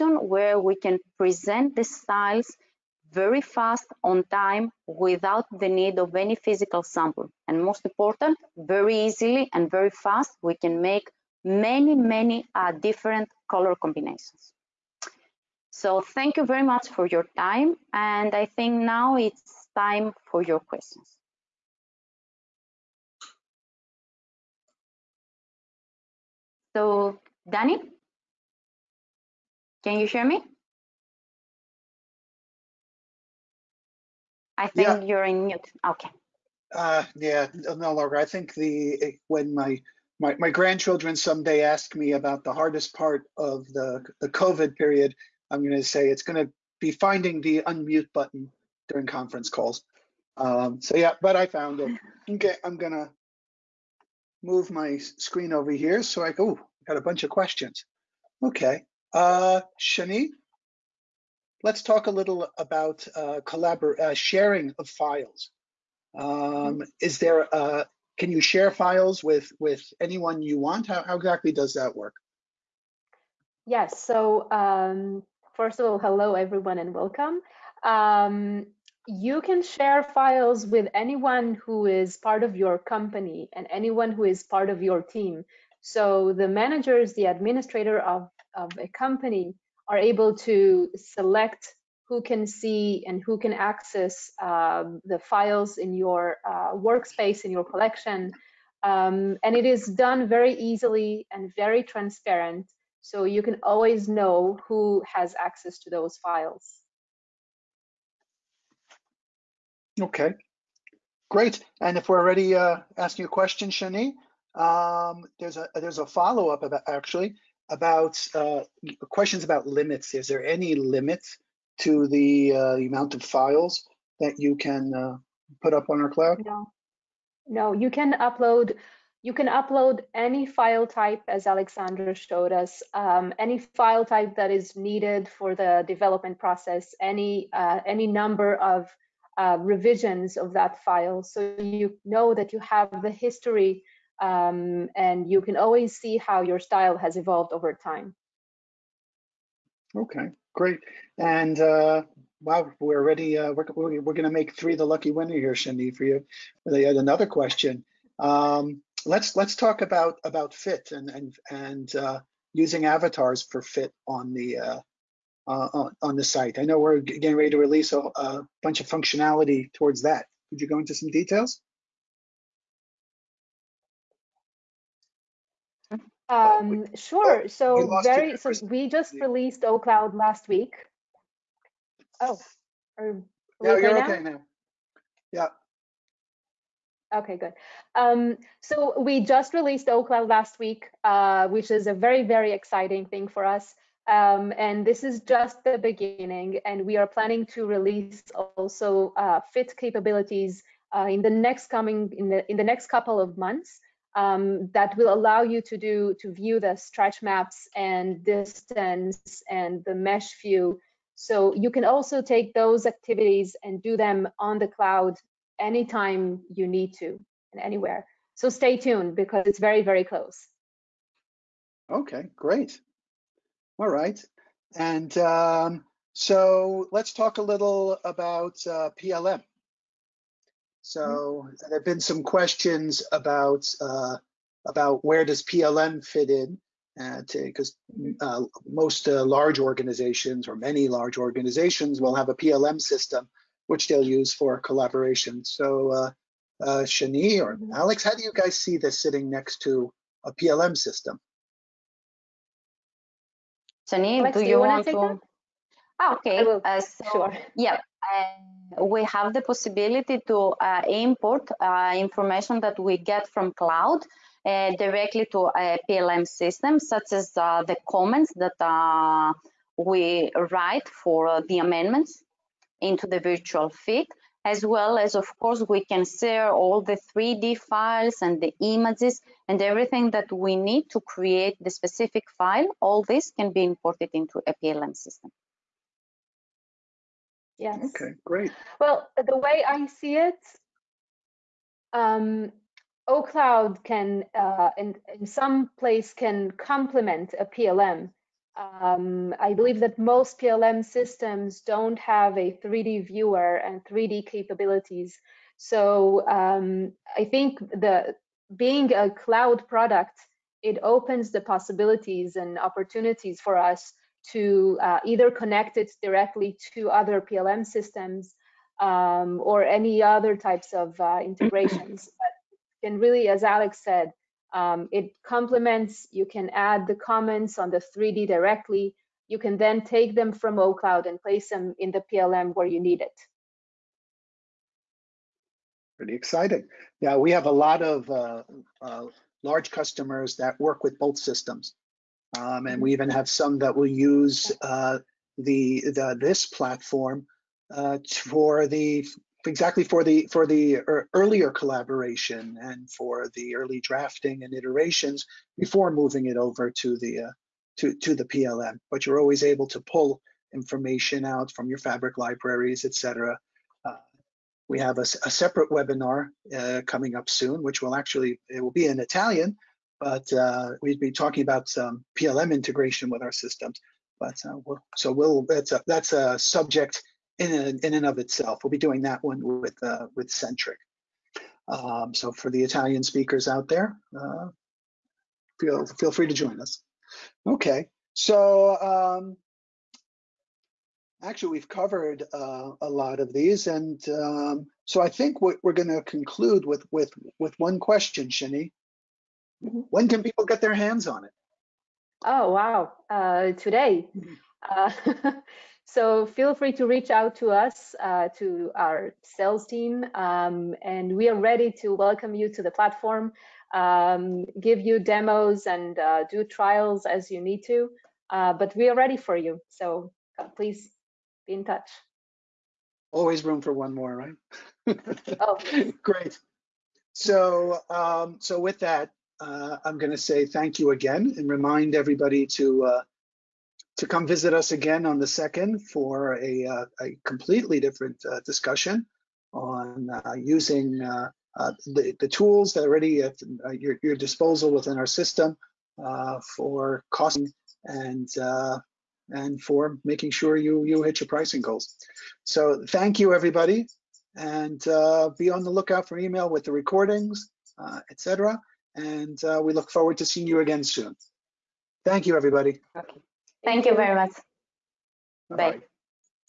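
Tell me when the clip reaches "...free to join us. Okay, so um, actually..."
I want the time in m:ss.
6:26.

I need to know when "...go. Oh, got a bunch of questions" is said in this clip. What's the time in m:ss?
0:56.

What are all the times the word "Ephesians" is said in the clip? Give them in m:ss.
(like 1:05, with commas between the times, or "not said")
not said.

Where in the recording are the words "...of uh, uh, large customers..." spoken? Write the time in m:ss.
5:37.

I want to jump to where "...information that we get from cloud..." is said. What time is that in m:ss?
4:21.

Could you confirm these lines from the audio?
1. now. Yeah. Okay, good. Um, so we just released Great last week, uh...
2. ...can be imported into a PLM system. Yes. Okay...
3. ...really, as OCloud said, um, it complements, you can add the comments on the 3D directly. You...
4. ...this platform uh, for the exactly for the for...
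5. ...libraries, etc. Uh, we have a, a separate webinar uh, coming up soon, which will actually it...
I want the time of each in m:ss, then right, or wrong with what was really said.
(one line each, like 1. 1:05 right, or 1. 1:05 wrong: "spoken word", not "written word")
1. 3:04 wrong: "OCloud", not "Great"
2. 4:43 right
3. 5:22 wrong: "Alex", not "OCloud"
4. 5:46 right
5. 6:02 right.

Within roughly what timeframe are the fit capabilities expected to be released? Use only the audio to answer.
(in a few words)
Next couple of months.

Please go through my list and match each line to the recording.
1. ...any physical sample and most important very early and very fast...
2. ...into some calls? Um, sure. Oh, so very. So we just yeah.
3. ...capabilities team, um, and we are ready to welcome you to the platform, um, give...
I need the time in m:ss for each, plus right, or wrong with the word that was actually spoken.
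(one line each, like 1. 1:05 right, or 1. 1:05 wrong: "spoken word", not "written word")
1. 0:06 wrong: "easily", not "early"
2. 2:50 wrong: "details", not "calls"
3. 6:49 wrong: "sales", not "capabilities".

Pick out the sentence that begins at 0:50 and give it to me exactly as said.
Um, so yeah, but I found it.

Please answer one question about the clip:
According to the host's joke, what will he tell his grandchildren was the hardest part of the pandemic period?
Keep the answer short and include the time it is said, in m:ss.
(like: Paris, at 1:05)
Finding the unmute button, at 0:46.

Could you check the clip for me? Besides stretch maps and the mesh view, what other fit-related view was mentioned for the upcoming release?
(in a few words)
Distance.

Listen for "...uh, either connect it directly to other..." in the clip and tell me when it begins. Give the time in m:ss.
5:14.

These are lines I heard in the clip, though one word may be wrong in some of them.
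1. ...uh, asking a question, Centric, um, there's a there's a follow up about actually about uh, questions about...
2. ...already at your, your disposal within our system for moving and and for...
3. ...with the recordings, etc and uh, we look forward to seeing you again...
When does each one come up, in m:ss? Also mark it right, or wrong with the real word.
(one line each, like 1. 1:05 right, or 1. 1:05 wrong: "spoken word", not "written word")
1. 1:52 wrong: "Shani", not "Centric"
2. 7:22 wrong: "costing", not "moving"
3. 7:36 right.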